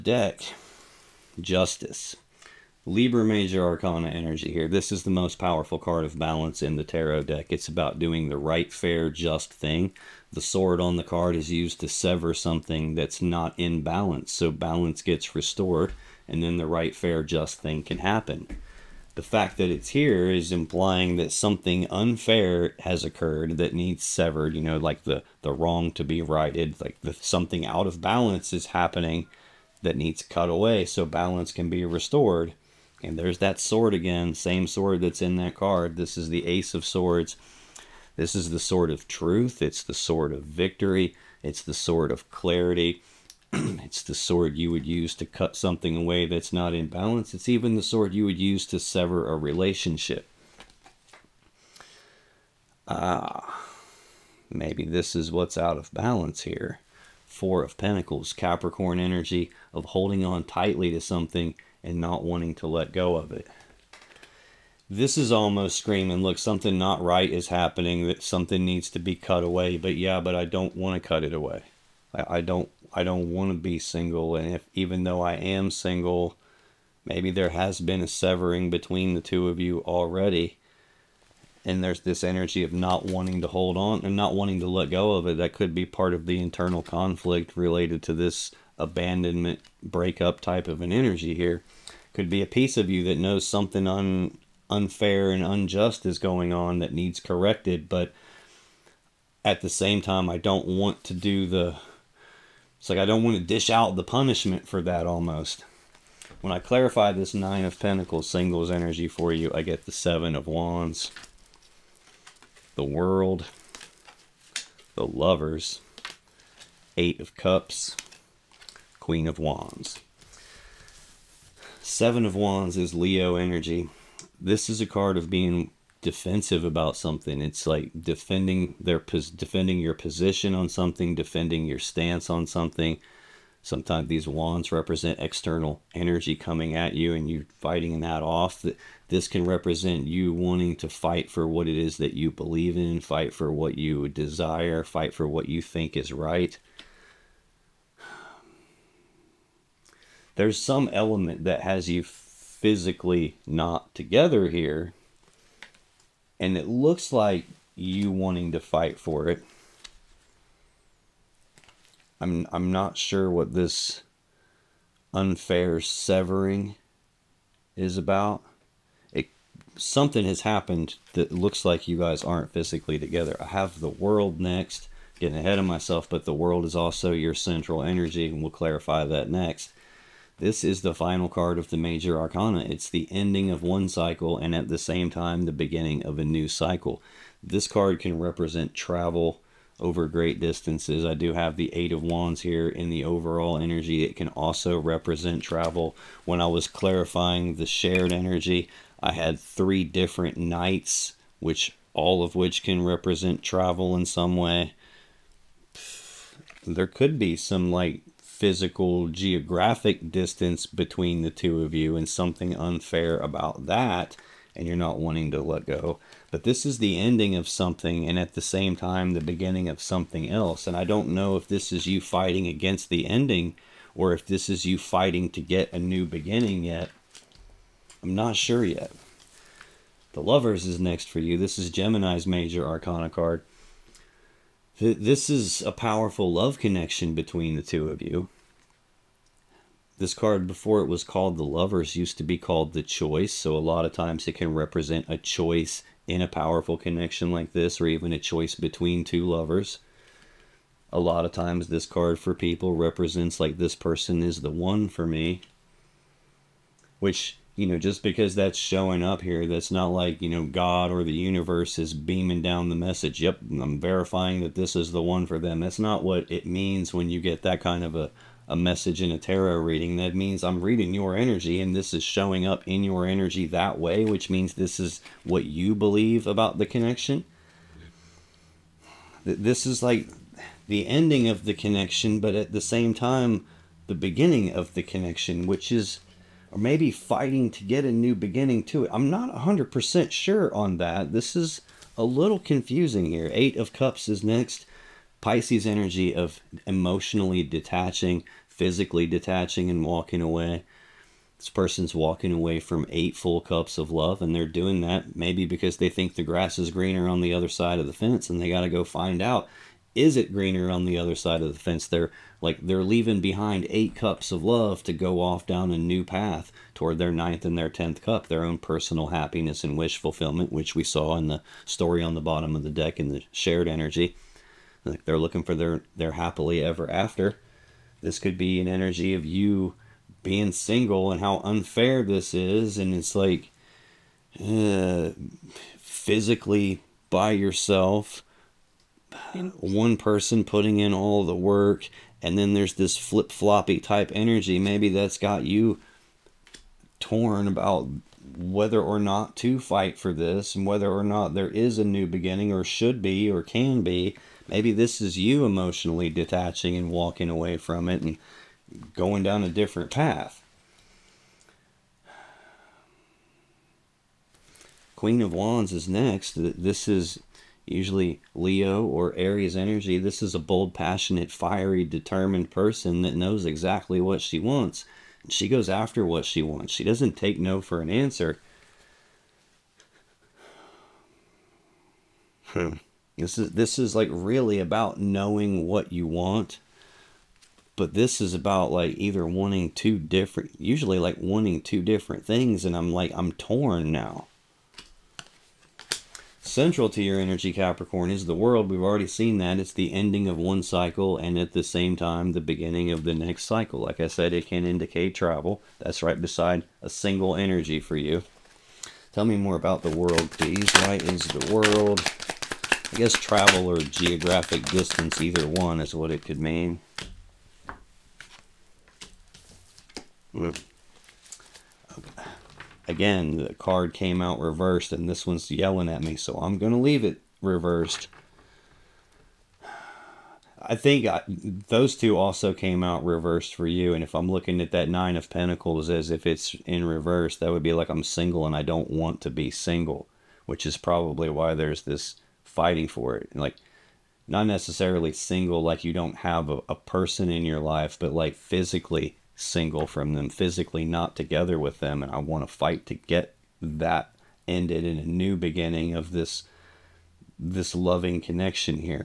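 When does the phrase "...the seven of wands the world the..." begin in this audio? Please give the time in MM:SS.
01:49.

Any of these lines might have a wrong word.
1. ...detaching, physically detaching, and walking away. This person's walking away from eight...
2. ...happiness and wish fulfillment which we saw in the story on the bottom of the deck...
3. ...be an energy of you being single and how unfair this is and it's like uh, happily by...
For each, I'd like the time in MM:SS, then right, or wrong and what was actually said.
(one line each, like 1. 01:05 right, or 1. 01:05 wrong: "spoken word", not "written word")
1. 04:57 right
2. 05:19 right
3. 05:28 wrong: "physically", not "happily".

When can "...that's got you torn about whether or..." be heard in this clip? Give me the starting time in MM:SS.
05:44.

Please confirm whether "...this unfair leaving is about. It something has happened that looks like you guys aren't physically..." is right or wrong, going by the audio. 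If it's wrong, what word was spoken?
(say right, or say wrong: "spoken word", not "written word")
wrong: "severing", not "leaving".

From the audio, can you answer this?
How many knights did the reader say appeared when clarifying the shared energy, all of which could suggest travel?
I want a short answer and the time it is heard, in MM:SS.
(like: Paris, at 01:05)
3, at 03:19.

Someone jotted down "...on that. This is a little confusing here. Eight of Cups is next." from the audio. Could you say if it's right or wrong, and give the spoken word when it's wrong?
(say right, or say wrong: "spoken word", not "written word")
right.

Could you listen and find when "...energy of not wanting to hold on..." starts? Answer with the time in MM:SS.
01:22.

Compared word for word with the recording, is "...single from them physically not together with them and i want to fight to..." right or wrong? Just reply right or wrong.
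right.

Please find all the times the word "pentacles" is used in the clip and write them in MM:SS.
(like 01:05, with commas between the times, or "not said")
00:57, 01:47, 07:15.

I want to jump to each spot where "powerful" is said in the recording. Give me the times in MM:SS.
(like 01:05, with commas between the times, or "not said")
00:05, 03:55, 04:06.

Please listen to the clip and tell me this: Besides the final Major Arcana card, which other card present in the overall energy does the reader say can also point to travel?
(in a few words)
Eight of Wands.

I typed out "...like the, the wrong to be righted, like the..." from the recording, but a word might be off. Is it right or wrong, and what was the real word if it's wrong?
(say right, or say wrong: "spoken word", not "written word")
right.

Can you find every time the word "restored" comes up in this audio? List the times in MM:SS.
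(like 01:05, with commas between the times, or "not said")
00:15, 00:31.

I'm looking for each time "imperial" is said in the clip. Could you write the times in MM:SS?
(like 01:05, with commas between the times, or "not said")
not said.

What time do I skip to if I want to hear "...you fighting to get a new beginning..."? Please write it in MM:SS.
03:44.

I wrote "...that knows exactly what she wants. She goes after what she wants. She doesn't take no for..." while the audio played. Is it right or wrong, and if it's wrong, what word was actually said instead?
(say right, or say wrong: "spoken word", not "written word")
right.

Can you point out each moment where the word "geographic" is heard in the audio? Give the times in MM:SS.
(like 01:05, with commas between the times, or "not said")
03:29, 06:53.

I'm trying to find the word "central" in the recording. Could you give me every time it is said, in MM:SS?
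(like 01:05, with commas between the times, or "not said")
02:57, 06:36.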